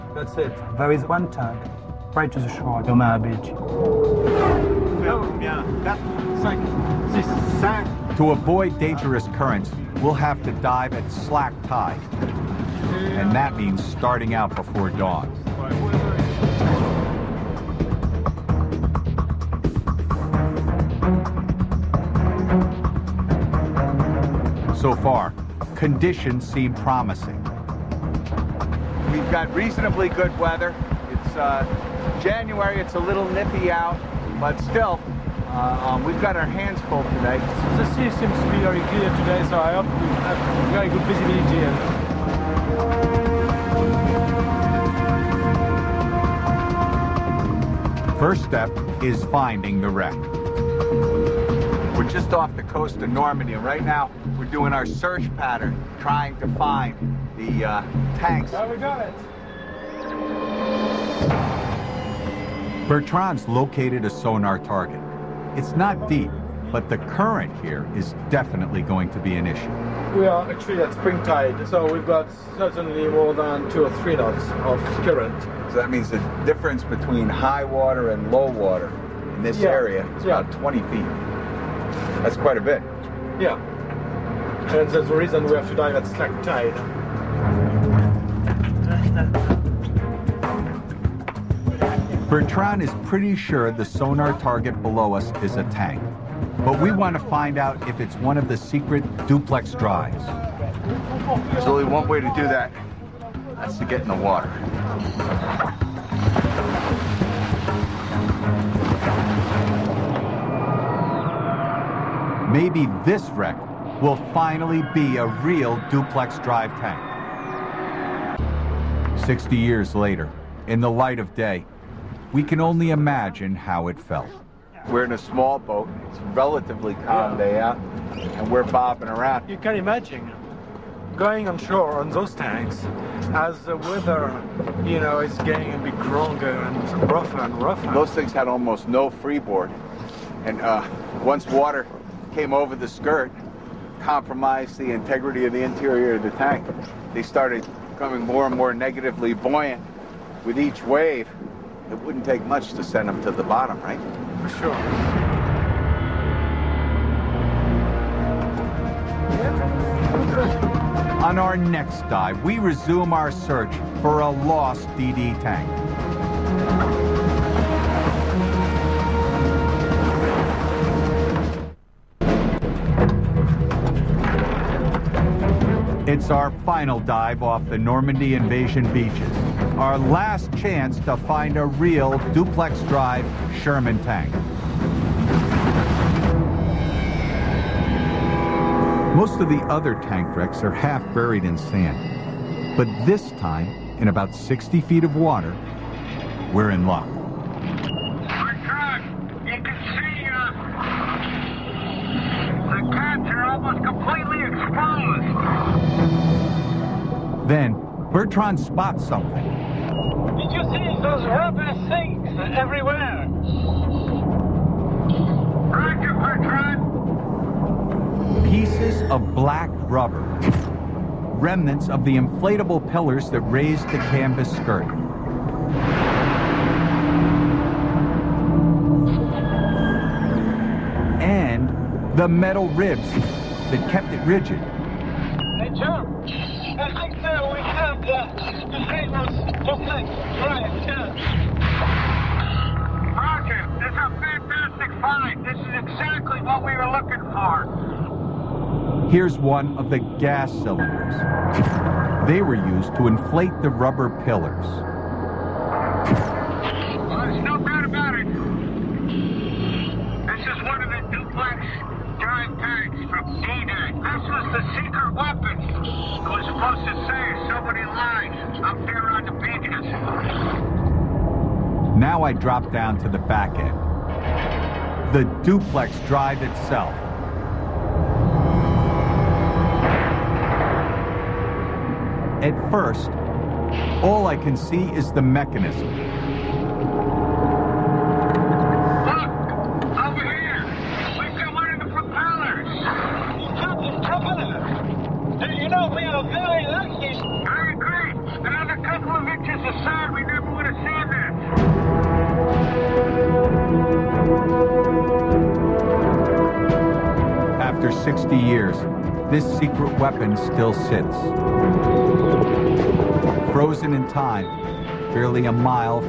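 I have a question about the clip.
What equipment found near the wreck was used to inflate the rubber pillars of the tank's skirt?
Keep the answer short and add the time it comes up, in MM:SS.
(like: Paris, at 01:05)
gas cylinders, at 04:09.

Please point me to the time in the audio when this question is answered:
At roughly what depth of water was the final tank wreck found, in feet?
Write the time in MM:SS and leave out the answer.
03:14.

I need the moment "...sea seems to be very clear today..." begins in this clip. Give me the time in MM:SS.
00:37.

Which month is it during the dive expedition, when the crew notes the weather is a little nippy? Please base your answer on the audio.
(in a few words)
January.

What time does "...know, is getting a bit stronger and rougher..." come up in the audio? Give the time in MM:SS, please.
02:14.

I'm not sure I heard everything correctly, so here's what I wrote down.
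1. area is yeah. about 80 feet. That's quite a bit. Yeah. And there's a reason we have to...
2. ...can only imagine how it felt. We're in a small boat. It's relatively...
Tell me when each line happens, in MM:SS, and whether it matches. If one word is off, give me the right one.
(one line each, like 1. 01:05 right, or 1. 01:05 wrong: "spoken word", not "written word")
1. 01:19 wrong: "20", not "80"
2. 02:02 right.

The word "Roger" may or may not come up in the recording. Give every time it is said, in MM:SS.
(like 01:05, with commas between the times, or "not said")
03:35, 04:03.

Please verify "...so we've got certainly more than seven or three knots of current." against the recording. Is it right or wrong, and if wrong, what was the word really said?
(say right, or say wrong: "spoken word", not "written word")
wrong: "two", not "seven".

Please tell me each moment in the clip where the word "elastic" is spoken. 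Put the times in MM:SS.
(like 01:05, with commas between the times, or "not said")
not said.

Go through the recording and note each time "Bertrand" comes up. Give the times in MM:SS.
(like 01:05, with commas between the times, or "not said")
01:02, 01:32, 03:28, 03:36.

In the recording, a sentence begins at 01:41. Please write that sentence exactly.
There's only one way to do that.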